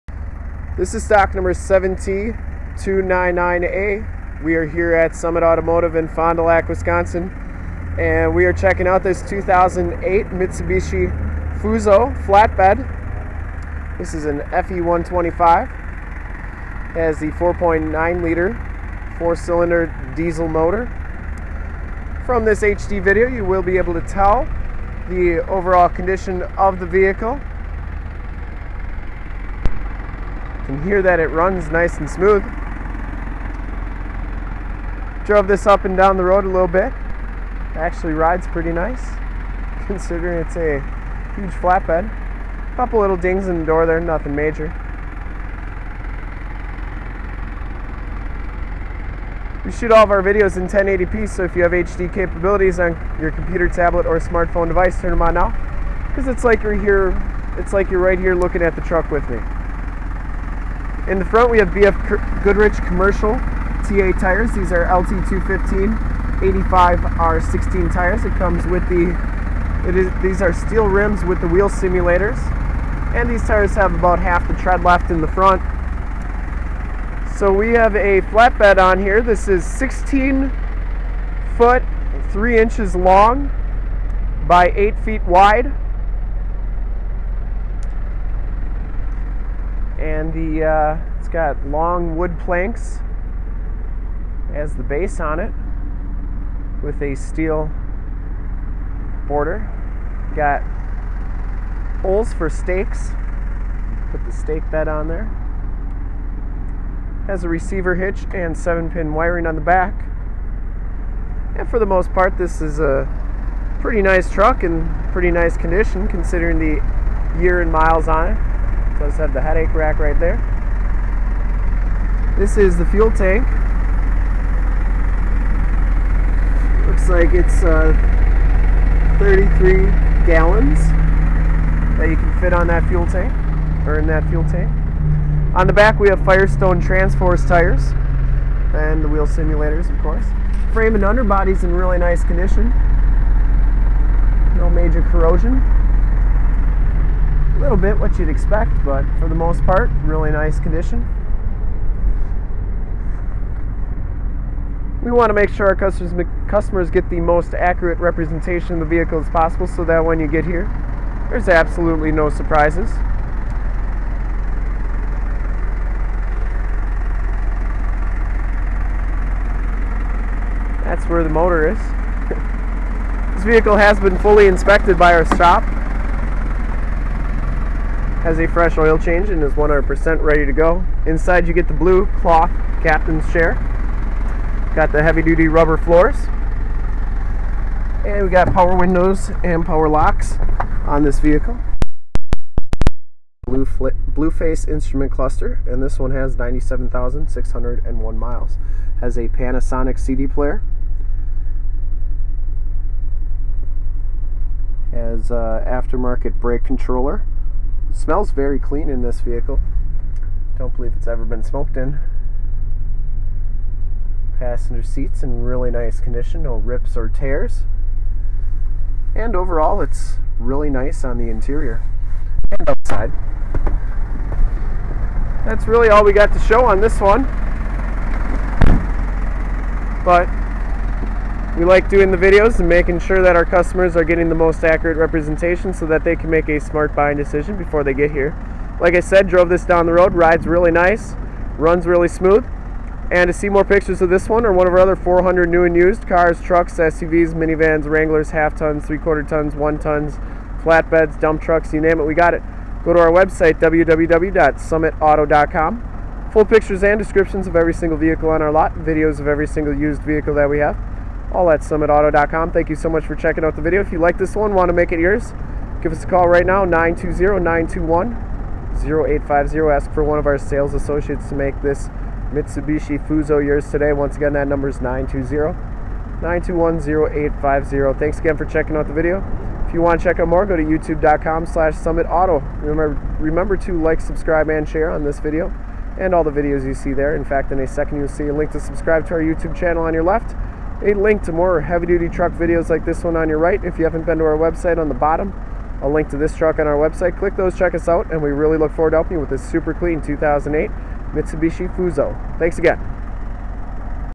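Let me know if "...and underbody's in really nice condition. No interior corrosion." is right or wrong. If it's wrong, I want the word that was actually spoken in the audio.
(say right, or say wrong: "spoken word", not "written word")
wrong: "major", not "interior".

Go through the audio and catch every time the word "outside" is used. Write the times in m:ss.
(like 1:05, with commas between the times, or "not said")
3:42.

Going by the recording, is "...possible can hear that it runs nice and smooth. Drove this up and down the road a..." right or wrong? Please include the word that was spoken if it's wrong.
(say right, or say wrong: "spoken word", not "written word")
wrong: "vehicle", not "possible".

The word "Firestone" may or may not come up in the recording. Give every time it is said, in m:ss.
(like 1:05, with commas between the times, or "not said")
2:16.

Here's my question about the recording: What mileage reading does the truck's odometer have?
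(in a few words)
97,601.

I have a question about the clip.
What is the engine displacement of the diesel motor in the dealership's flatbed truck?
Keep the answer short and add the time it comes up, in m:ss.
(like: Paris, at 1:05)
4.9 liter, at 0:17.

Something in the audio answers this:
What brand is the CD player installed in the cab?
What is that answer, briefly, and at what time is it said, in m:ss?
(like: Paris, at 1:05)
Panasonic, at 3:19.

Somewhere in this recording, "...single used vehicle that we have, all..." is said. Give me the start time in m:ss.
4:19.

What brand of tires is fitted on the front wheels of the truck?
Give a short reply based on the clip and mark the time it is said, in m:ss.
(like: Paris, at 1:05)
BF Goodrich, at 1:01.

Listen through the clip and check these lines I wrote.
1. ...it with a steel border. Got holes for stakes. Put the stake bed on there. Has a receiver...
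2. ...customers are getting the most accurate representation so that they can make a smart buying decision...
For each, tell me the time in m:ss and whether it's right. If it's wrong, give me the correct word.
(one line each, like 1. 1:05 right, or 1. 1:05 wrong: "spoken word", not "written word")
1. 1:35 right
2. 3:53 right.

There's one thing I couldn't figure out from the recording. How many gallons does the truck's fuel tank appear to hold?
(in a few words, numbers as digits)
33.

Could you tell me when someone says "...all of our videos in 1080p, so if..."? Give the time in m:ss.
0:49.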